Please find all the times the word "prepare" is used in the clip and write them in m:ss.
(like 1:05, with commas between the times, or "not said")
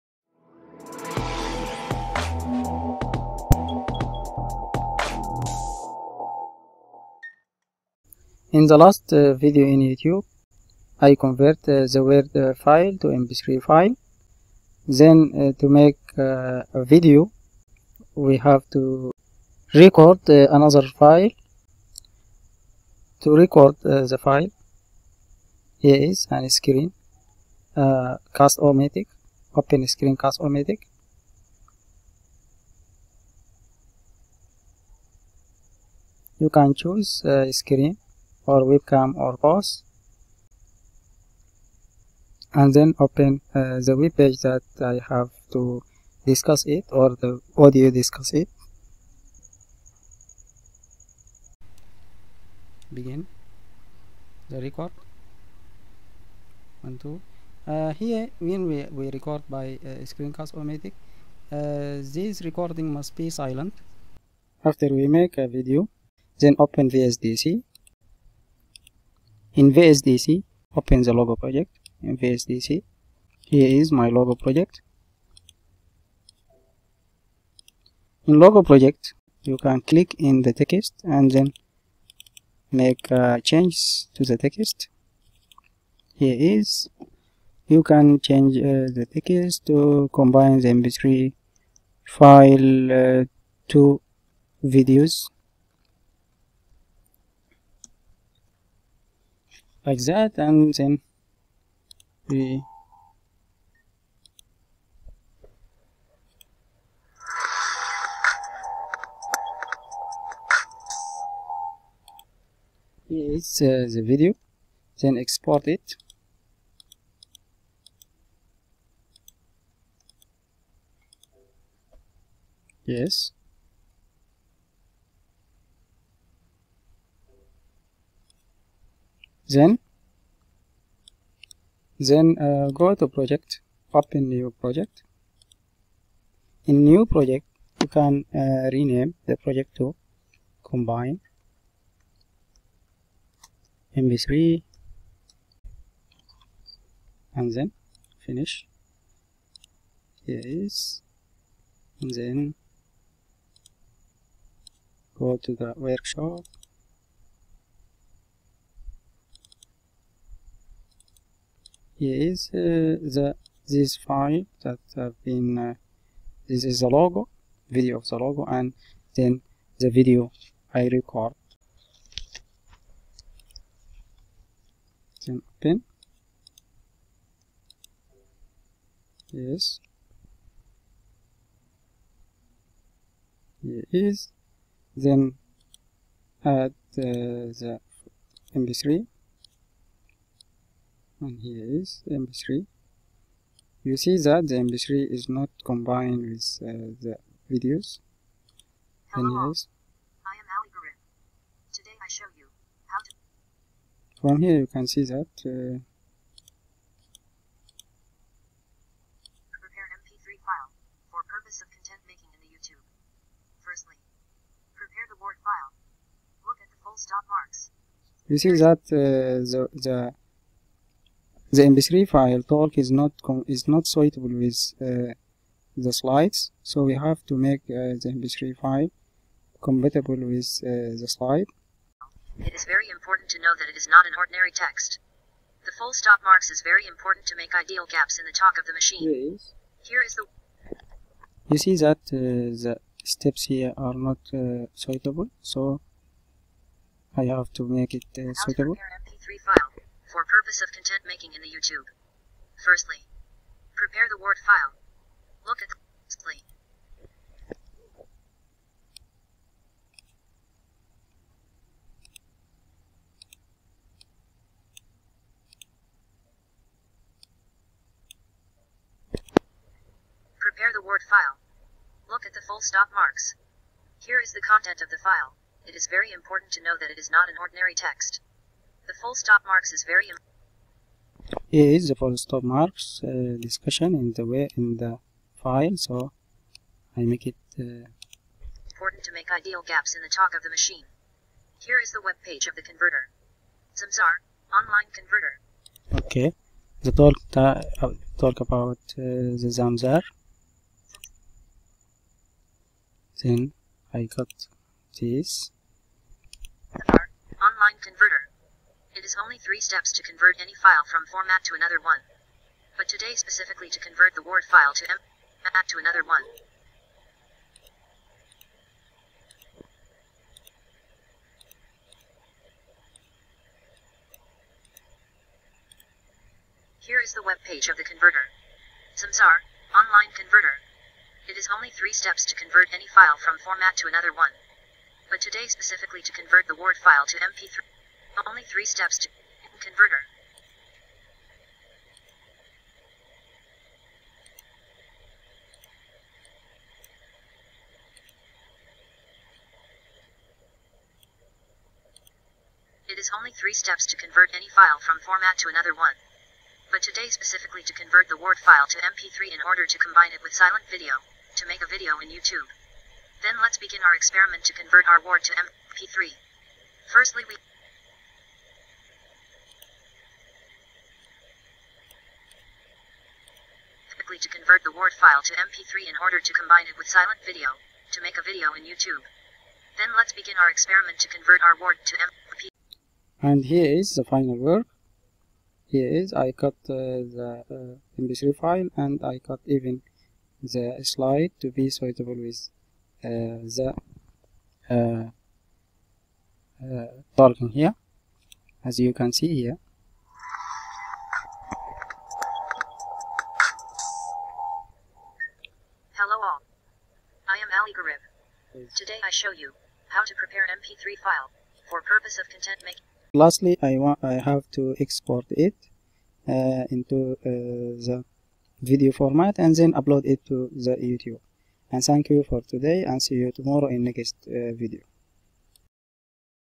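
3:29, 3:34, 4:13, 4:30, 6:50.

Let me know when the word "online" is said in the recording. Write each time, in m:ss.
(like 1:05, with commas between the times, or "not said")
4:54, 5:07, 5:29.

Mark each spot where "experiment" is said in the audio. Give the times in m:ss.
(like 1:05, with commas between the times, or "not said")
6:03, 6:20.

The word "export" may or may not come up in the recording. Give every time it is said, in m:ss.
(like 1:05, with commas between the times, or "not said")
1:55, 6:54.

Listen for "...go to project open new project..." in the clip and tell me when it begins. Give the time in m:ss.
2:12.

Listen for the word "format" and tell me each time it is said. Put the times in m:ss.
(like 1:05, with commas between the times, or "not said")
5:11, 5:33, 5:54, 6:58.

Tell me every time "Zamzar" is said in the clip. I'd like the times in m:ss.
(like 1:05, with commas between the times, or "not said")
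4:53, 4:59, 5:28.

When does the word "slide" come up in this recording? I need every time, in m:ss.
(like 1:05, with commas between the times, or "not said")
3:45, 3:51, 6:30.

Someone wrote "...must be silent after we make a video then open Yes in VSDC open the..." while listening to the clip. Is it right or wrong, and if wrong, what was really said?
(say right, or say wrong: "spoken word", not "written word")
wrong: "VSDC", not "Yes".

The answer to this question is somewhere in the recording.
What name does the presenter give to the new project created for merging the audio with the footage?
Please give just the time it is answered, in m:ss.
2:18.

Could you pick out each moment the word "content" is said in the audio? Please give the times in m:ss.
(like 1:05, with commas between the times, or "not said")
3:31, 4:10, 4:34, 6:52.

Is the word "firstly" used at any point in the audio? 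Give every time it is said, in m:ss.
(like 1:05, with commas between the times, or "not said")
3:33, 4:12, 6:06.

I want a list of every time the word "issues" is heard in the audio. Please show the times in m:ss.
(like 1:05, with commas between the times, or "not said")
not said.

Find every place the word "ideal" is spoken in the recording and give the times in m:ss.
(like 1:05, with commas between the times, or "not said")
3:57, 4:49.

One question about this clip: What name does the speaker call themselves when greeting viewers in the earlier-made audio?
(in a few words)
algorithm.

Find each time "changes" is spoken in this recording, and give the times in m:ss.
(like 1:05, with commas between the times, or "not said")
1:23, 1:28.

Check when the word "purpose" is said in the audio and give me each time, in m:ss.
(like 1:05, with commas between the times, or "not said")
3:31, 4:10, 6:51.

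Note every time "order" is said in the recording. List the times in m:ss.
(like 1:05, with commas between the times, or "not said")
5:59, 6:16.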